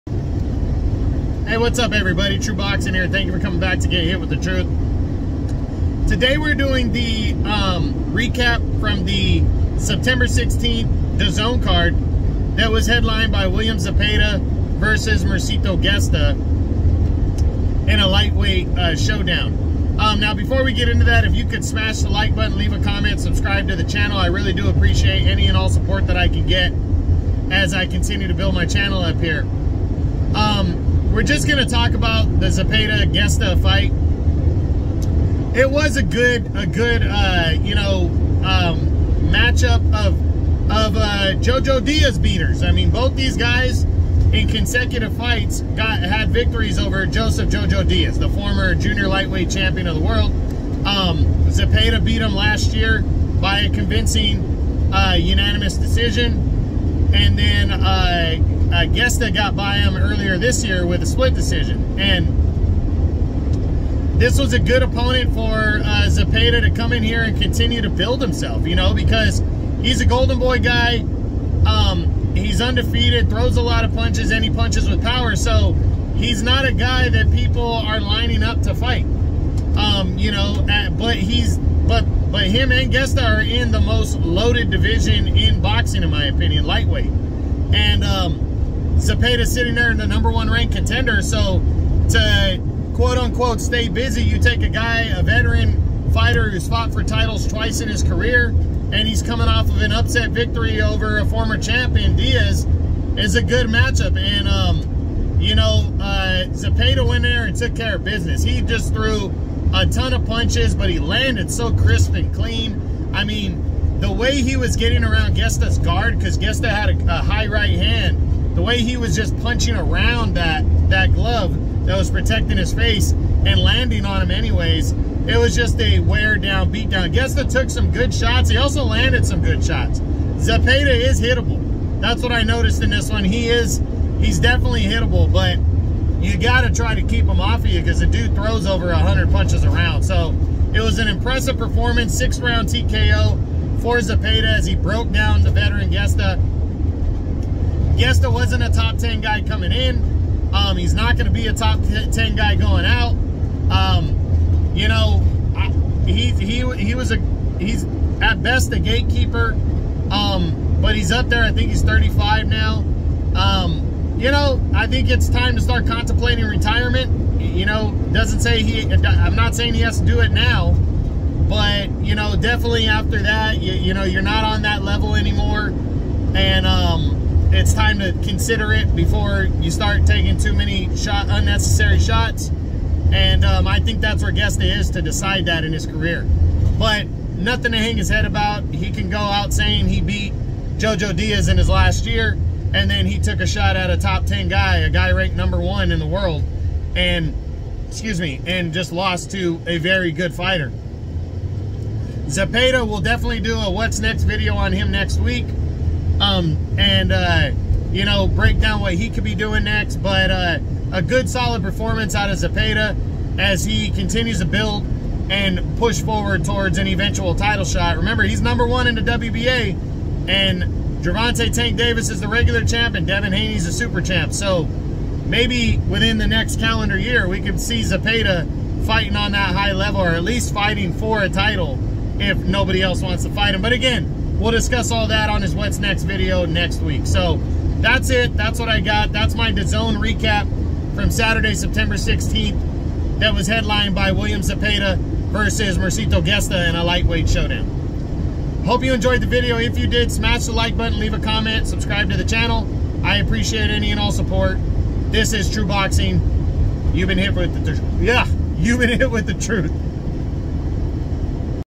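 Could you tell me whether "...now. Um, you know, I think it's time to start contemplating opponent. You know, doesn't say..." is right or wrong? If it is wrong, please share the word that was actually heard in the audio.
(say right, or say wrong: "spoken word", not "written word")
wrong: "retirement", not "opponent".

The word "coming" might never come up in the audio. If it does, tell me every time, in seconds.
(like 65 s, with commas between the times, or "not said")
3 s, 99 s, 149 s.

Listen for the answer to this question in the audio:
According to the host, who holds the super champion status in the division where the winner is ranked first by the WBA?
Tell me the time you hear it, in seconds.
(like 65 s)
223 s.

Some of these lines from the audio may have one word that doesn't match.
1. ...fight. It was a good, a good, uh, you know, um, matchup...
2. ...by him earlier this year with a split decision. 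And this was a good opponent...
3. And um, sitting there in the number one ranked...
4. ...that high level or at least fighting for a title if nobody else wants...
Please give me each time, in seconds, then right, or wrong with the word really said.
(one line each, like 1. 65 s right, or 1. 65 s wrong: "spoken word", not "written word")
1. 33 s right
2. 59 s right
3. 87 s right
4. 229 s right.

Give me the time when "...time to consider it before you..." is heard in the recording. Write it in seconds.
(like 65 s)
177 s.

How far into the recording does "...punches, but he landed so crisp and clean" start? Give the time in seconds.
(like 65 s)
110 s.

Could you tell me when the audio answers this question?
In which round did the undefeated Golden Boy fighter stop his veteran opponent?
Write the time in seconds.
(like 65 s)
142 s.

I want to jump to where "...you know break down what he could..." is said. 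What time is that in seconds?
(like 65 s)
207 s.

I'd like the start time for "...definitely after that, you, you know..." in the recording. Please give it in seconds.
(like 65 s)
172 s.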